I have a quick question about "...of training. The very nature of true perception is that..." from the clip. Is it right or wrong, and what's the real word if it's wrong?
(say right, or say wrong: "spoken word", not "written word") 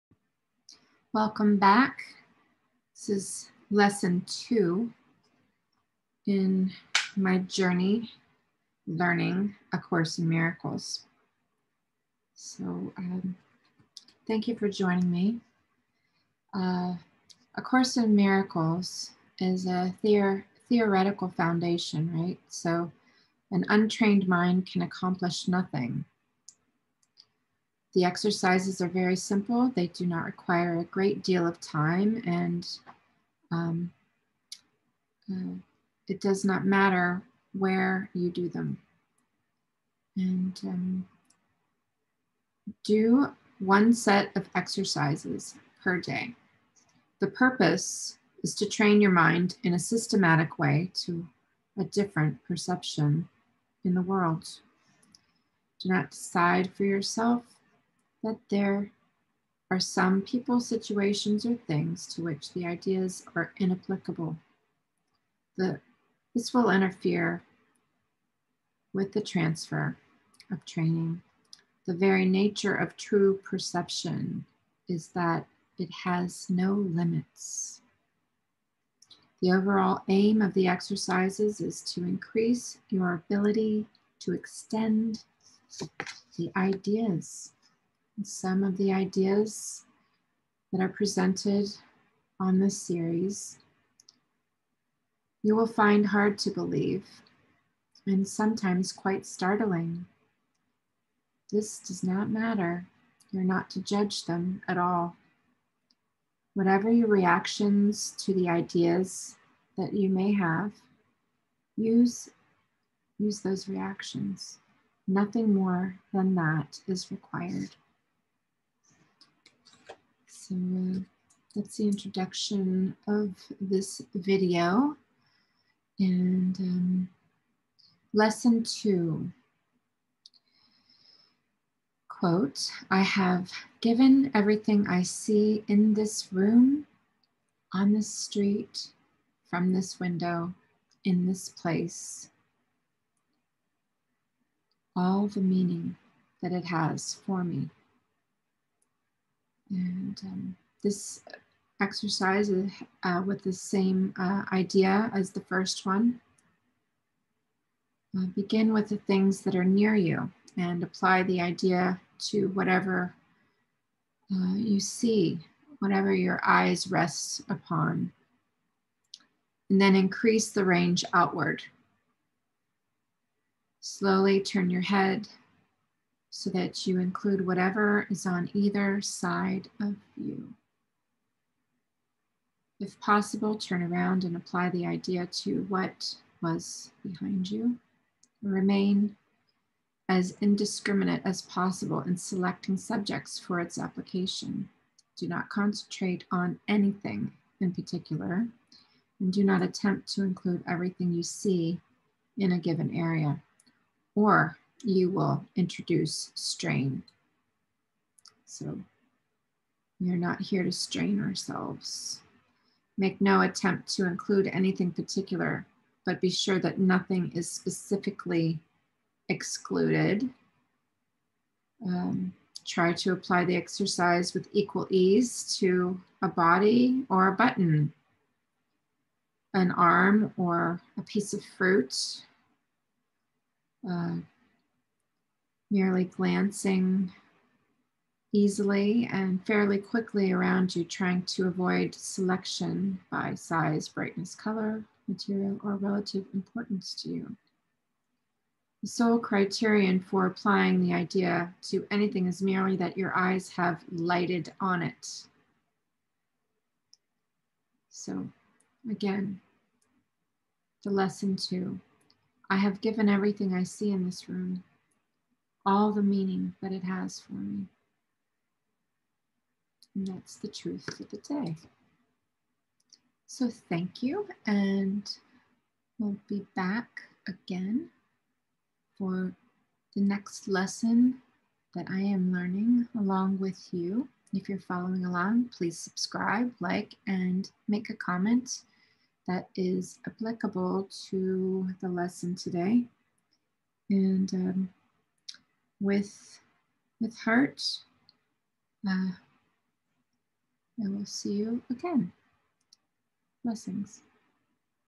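right.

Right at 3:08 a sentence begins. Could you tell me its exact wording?
Remain as indiscriminate as possible in selecting subjects for its application.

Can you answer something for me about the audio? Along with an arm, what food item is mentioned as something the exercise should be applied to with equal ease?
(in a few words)
a piece of fruit.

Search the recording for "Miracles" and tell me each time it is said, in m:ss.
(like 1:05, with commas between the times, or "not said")
0:10, 0:18.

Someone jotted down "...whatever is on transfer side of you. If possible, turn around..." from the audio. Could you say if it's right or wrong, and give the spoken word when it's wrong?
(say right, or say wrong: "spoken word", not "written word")
wrong: "either", not "transfer".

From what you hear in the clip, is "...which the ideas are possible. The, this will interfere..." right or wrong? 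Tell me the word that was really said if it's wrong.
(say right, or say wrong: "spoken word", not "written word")
wrong: "inapplicable", not "possible".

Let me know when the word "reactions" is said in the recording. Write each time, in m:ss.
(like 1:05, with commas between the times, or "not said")
1:47, 1:53.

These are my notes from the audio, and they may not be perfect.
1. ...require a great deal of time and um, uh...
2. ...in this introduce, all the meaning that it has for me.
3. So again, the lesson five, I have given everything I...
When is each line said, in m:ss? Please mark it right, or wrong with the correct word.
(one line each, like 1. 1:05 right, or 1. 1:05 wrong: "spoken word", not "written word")
1. 0:30 right
2. 2:21 wrong: "place", not "introduce"
3. 4:17 wrong: "two", not "five".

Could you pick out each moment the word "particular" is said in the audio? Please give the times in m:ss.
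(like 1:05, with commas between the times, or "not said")
3:17, 3:34.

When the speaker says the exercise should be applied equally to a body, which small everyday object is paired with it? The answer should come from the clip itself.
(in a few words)
a button.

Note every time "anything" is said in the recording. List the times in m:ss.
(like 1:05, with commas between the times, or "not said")
3:16, 3:34, 4:11.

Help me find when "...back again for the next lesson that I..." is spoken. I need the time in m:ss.
4:36.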